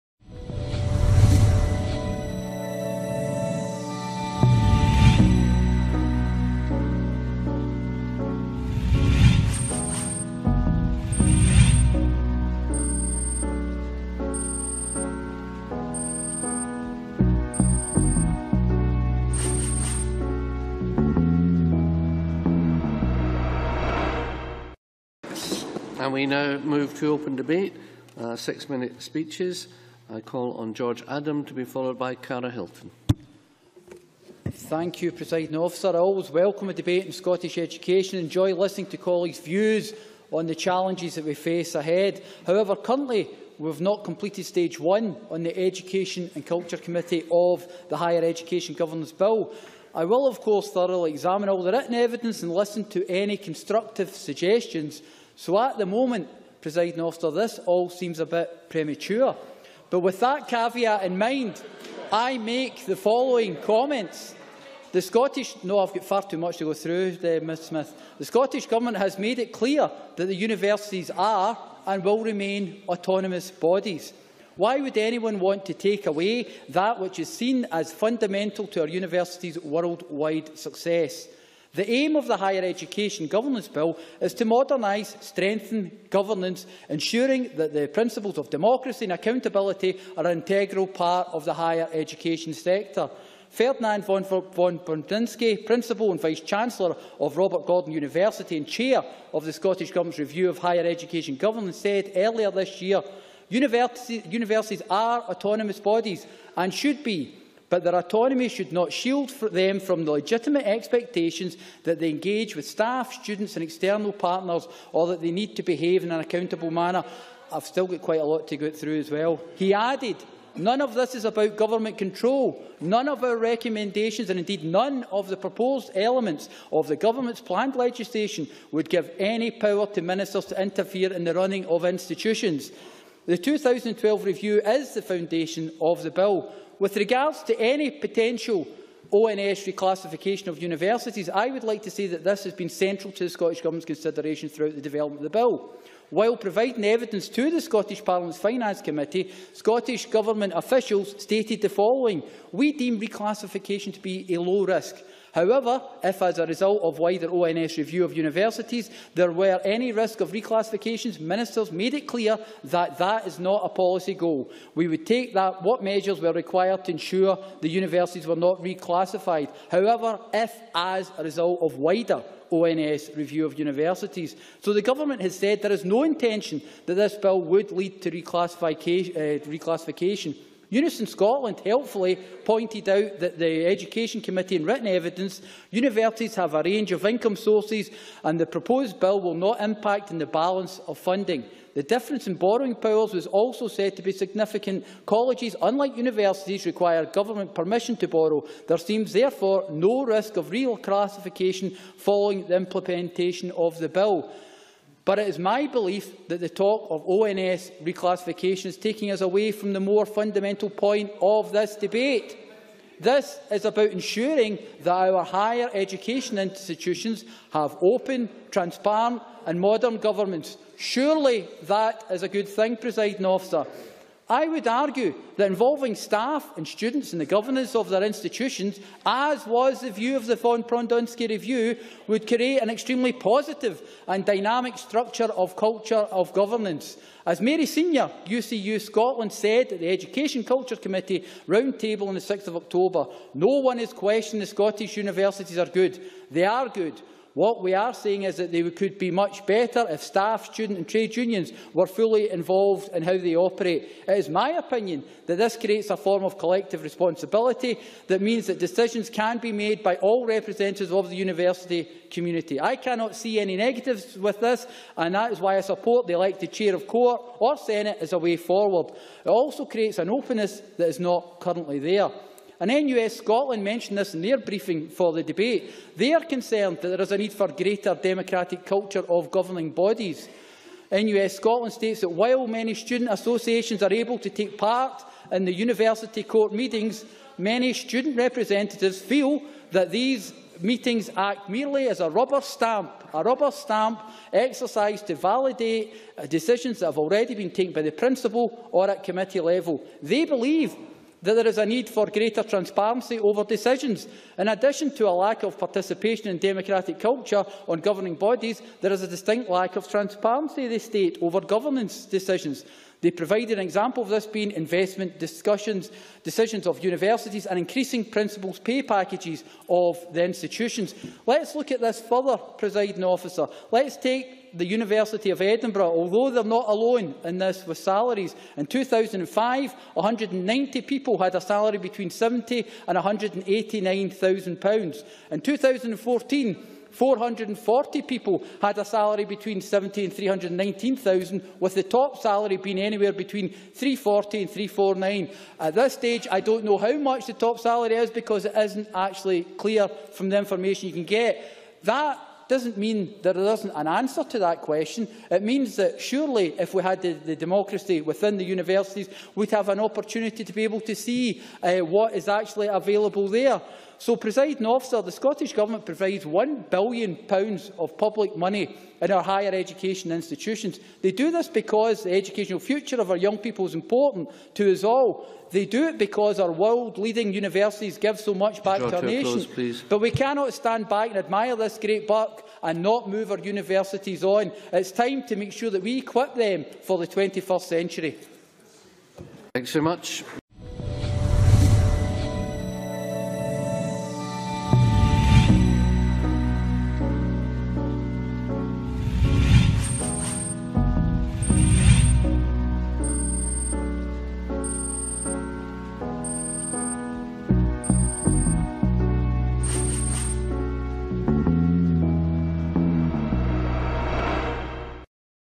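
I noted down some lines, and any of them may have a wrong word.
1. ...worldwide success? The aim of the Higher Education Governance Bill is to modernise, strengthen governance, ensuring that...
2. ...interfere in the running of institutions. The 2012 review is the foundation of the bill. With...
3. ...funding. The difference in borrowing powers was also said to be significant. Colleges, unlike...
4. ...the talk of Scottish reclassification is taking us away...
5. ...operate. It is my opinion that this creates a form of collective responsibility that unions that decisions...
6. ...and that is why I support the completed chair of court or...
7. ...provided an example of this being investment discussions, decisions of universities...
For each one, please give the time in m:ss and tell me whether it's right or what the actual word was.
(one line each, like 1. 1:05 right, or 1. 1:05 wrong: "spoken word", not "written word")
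1. 1:19 right
2. 2:10 right
3. 3:10 right
4. 3:26 wrong: "ONS", not "Scottish"
5. 4:13 wrong: "means", not "unions"
6. 4:24 wrong: "elected", not "completed"
7. 5:13 right.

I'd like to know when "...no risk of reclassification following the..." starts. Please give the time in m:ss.
3:19.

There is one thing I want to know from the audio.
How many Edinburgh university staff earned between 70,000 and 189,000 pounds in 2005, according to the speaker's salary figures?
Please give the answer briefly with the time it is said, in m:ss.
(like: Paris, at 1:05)
190, at 5:29.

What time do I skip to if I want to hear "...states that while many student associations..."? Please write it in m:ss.
4:41.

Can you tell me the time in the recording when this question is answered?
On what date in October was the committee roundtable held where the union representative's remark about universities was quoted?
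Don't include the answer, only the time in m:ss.
4:02.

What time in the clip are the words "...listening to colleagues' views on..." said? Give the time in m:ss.
0:38.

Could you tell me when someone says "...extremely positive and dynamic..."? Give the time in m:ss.
3:52.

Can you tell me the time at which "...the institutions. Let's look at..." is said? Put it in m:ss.
5:20.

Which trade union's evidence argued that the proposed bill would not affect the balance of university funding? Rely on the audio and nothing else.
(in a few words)
Unison Scotland.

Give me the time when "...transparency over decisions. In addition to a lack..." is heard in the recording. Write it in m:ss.
5:02.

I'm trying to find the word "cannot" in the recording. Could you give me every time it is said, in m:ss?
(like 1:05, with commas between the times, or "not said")
4:22, 6:20.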